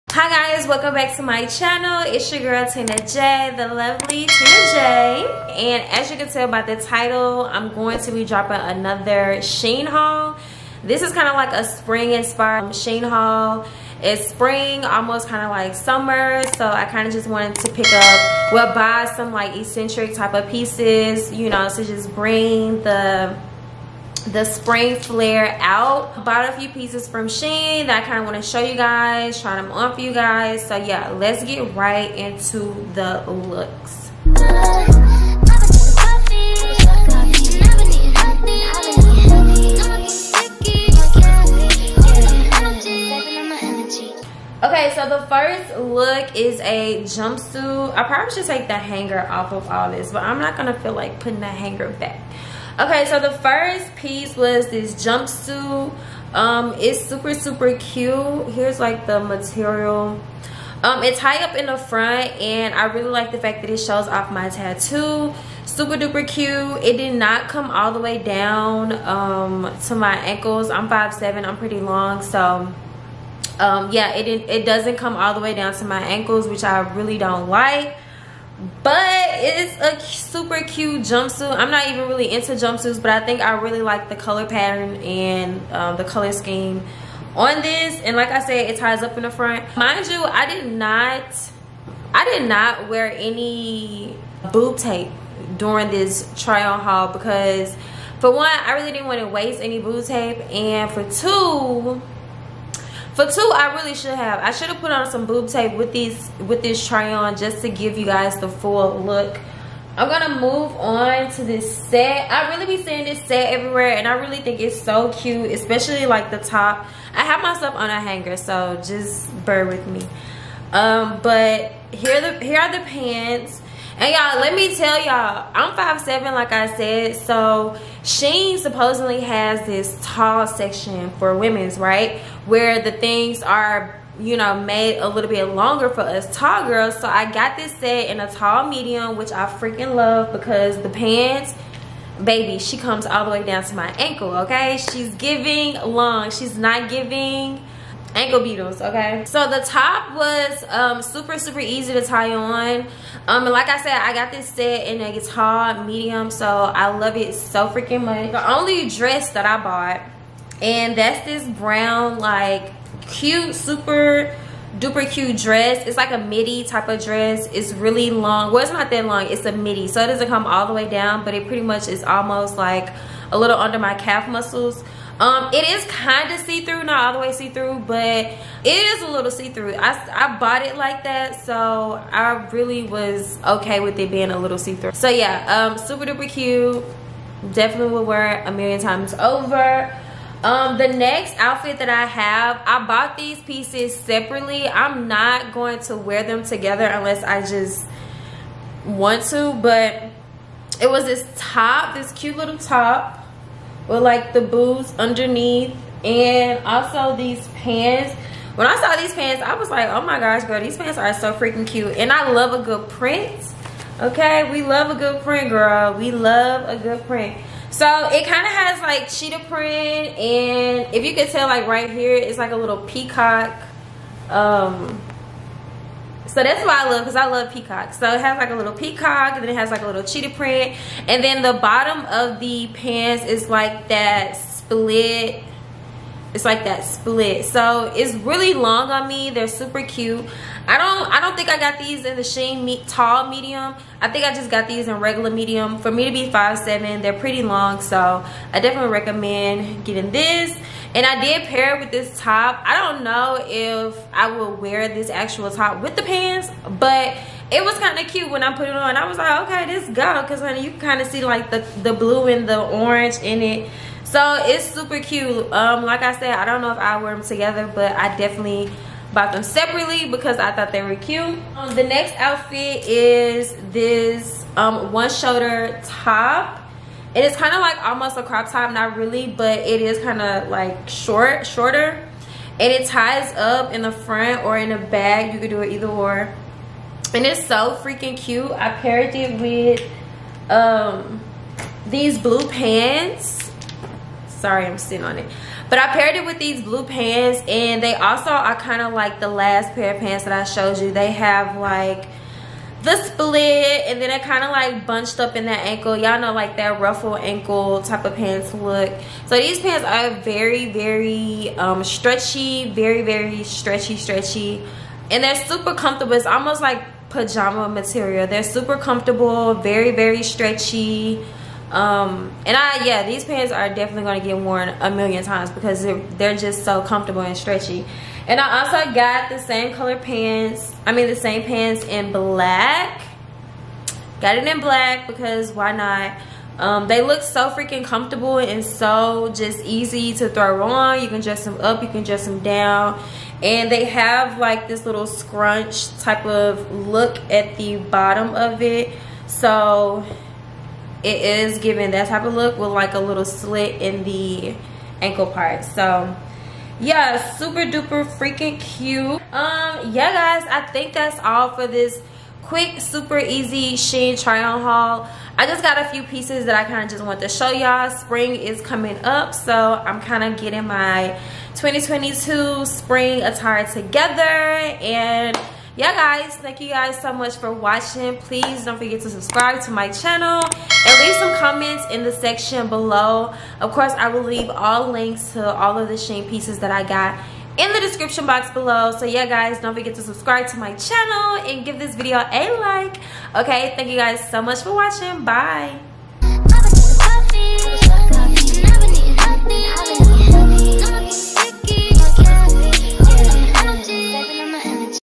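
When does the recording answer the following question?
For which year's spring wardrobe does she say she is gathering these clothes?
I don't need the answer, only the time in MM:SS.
06:11.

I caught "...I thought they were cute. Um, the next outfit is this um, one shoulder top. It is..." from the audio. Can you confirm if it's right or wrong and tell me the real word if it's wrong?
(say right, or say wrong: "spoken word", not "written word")
right.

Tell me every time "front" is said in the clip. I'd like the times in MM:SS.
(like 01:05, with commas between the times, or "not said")
01:01, 01:29, 04:43.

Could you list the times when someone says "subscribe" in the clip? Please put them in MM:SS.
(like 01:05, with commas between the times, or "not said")
06:19, 06:30.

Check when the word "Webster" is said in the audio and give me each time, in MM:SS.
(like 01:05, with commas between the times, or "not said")
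not said.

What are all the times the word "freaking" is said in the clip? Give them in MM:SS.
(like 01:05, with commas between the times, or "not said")
02:19, 02:37, 03:31, 04:47, 05:37, 05:58.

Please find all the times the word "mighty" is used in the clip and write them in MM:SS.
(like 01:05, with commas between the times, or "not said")
not said.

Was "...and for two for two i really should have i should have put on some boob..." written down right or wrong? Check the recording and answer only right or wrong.
right.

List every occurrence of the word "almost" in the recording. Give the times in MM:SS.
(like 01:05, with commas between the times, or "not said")
00:14, 02:52, 04:37, 05:16.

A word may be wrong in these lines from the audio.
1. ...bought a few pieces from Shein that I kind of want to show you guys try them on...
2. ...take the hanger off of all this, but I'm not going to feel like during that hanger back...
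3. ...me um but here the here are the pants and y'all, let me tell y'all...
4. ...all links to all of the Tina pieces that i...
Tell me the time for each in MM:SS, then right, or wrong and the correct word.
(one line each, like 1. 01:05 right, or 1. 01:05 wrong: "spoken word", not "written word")
1. 00:26 right
2. 00:48 wrong: "putting", not "during"
3. 01:59 right
4. 06:24 wrong: "Shein", not "Tina".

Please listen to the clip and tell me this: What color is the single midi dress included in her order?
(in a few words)
brown.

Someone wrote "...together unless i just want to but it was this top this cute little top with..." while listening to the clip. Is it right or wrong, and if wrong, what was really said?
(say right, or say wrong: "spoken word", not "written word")
right.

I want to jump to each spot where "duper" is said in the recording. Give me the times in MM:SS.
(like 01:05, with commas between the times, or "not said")
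01:05, 02:44, 03:06, 05:57.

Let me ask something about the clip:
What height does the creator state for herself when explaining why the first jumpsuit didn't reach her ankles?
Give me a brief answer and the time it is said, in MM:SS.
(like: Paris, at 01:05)
5'7, at 01:10.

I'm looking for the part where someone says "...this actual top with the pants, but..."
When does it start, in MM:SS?
04:14.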